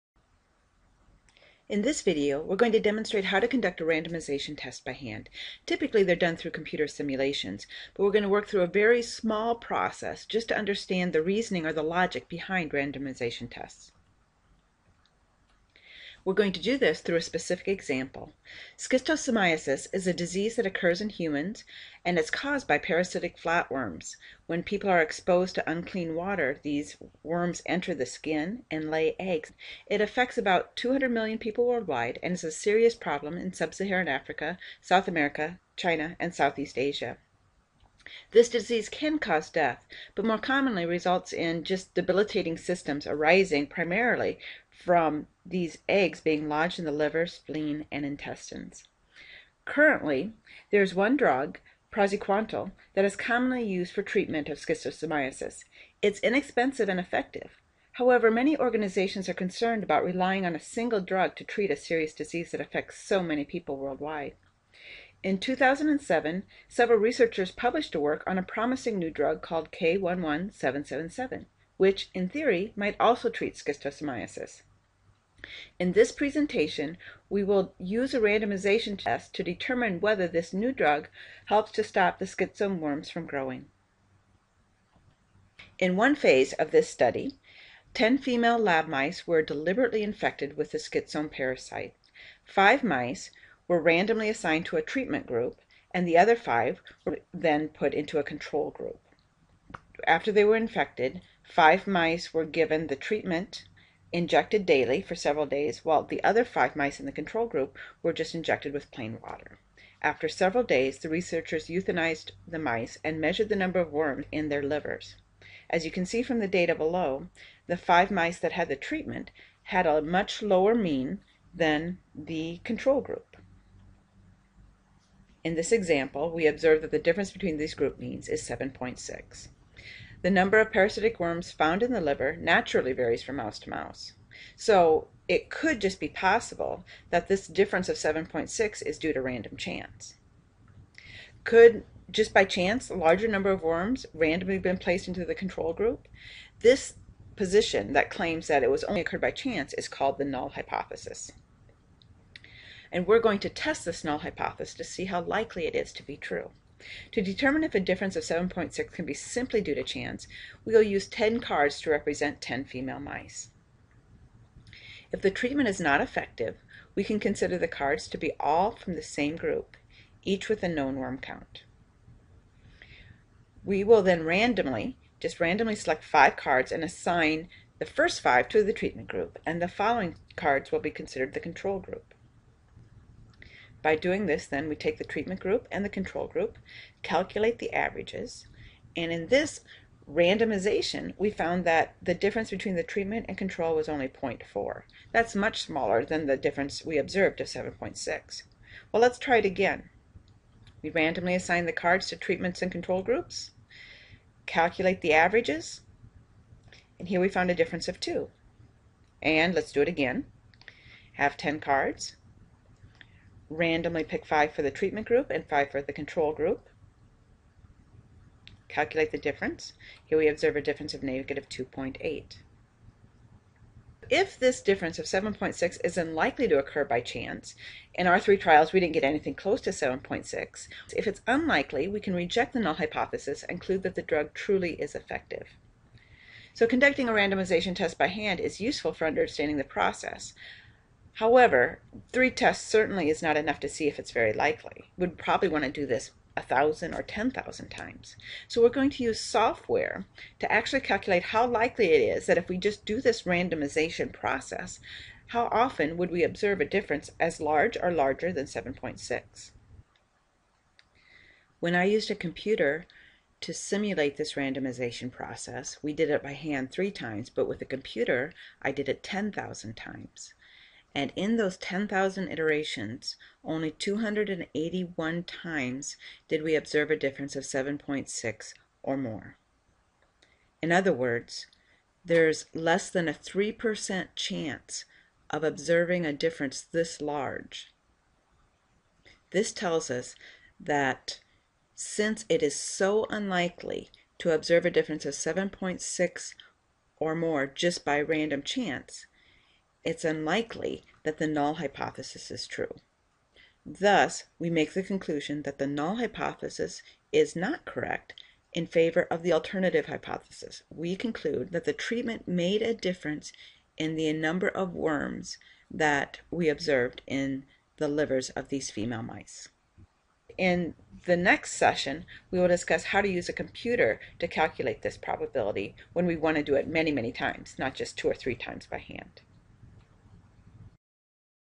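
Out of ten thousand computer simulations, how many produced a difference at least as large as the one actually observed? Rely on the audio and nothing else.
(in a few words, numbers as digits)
281.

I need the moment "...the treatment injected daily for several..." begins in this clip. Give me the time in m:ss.
1:42.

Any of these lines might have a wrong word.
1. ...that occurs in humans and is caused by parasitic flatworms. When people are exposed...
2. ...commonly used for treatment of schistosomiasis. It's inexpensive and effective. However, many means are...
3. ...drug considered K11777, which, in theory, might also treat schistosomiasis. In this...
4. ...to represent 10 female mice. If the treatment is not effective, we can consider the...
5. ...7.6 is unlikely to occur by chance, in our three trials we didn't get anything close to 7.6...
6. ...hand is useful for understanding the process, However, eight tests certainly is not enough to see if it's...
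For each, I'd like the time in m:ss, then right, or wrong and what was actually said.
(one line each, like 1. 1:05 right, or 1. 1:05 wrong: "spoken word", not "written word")
1. 0:20 right
2. 0:53 wrong: "organizations", not "means"
3. 1:09 wrong: "called", not "considered"
4. 2:41 right
5. 3:45 right
6. 3:58 wrong: "three", not "eight".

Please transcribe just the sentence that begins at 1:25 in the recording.
In one phase of this study, 10 female lab mice were deliberately infected with the schistosome parasite.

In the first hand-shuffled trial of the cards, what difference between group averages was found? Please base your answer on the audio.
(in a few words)
0.4.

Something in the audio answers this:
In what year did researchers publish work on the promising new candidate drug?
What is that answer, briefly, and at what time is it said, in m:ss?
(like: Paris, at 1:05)
2007, at 1:05.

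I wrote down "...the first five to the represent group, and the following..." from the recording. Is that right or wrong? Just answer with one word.
wrong.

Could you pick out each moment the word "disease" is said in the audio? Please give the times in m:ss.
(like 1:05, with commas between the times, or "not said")
0:20, 0:38, 1:02.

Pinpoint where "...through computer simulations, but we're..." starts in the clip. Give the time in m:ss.
0:06.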